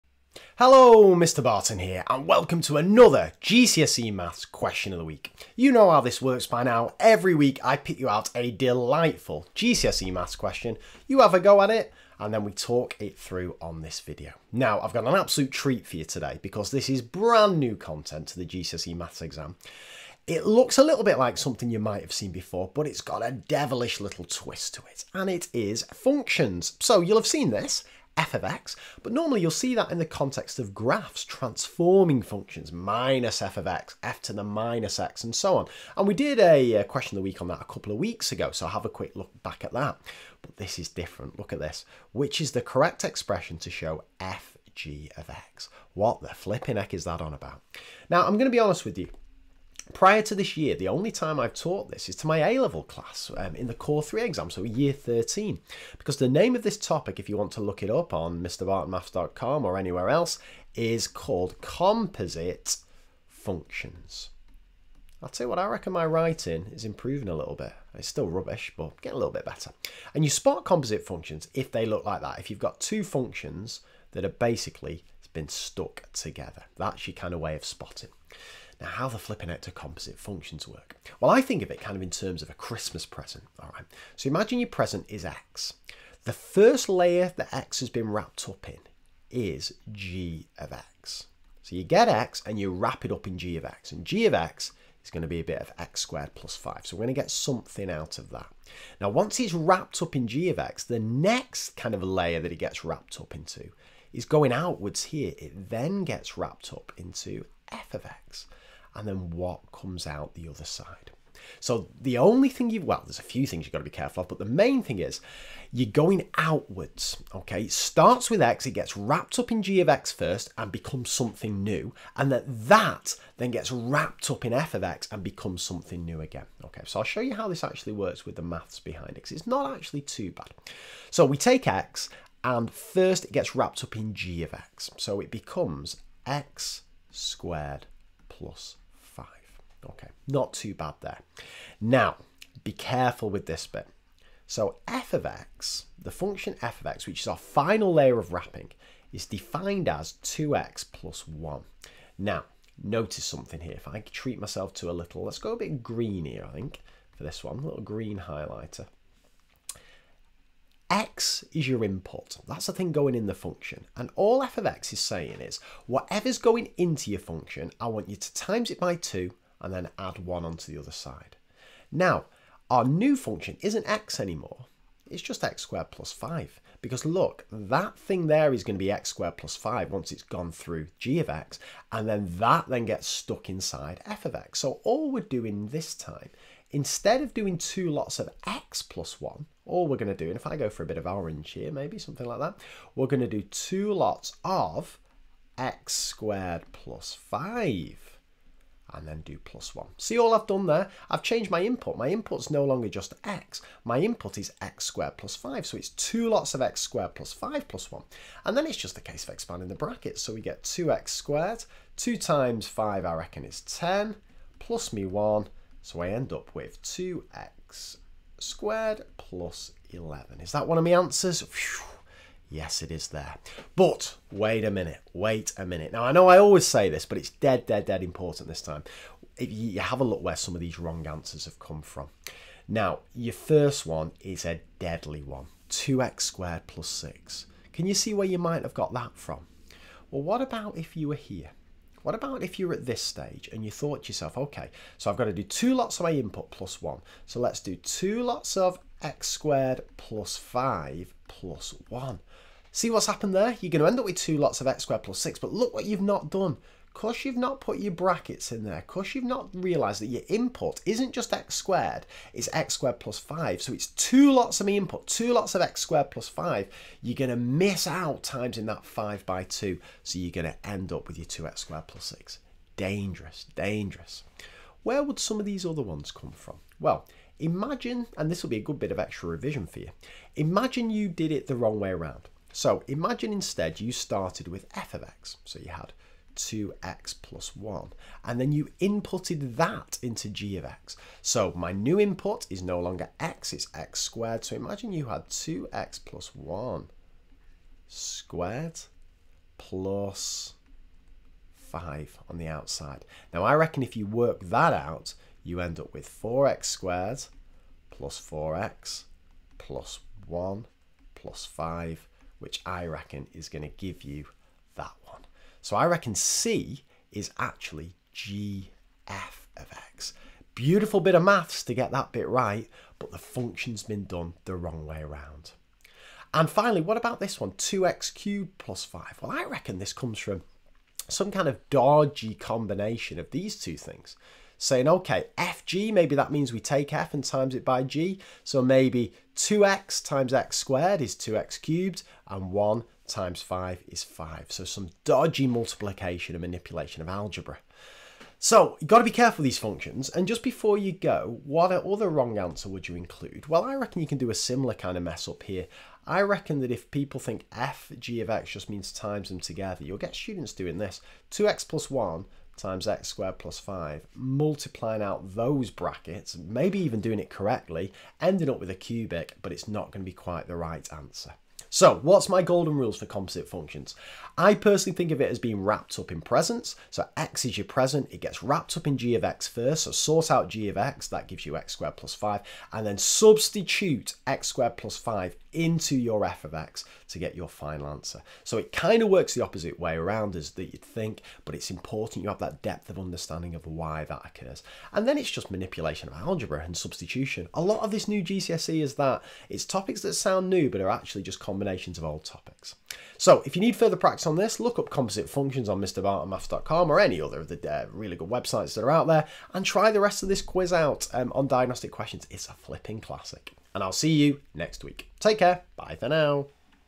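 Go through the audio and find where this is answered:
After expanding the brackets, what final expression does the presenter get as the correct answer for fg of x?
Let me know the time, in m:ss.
3:36.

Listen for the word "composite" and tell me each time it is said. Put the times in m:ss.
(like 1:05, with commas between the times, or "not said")
1:01, 1:10, 1:19, 6:13, 6:44.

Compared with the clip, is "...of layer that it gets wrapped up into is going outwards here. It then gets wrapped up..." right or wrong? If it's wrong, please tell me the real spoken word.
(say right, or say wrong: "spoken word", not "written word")
right.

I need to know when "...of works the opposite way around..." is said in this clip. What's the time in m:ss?
6:29.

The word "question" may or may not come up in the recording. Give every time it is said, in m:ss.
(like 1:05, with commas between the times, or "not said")
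0:04, 0:10, 0:36, 6:51.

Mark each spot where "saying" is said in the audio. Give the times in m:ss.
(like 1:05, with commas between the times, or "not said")
2:44, 5:34.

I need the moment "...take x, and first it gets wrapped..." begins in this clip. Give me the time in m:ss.
2:11.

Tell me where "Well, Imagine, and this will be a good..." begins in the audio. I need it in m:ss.
4:36.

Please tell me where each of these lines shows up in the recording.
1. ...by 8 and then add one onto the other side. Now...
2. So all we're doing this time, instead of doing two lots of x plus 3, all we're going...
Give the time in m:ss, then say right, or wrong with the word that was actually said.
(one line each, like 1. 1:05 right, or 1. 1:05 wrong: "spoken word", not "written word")
1. 2:48 wrong: "2", not "8"
2. 3:04 wrong: "1", not "3".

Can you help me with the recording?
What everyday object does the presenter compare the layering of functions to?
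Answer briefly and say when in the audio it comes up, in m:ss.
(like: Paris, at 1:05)
A Christmas present, at 1:22.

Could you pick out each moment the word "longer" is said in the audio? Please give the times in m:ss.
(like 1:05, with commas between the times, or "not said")
3:22, 4:52.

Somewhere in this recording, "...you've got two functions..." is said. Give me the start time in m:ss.
1:12.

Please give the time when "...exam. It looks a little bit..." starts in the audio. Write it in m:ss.
0:19.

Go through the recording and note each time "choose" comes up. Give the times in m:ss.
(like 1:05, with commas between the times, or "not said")
not said.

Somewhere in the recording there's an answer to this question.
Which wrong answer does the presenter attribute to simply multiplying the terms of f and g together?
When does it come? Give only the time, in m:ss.
5:27.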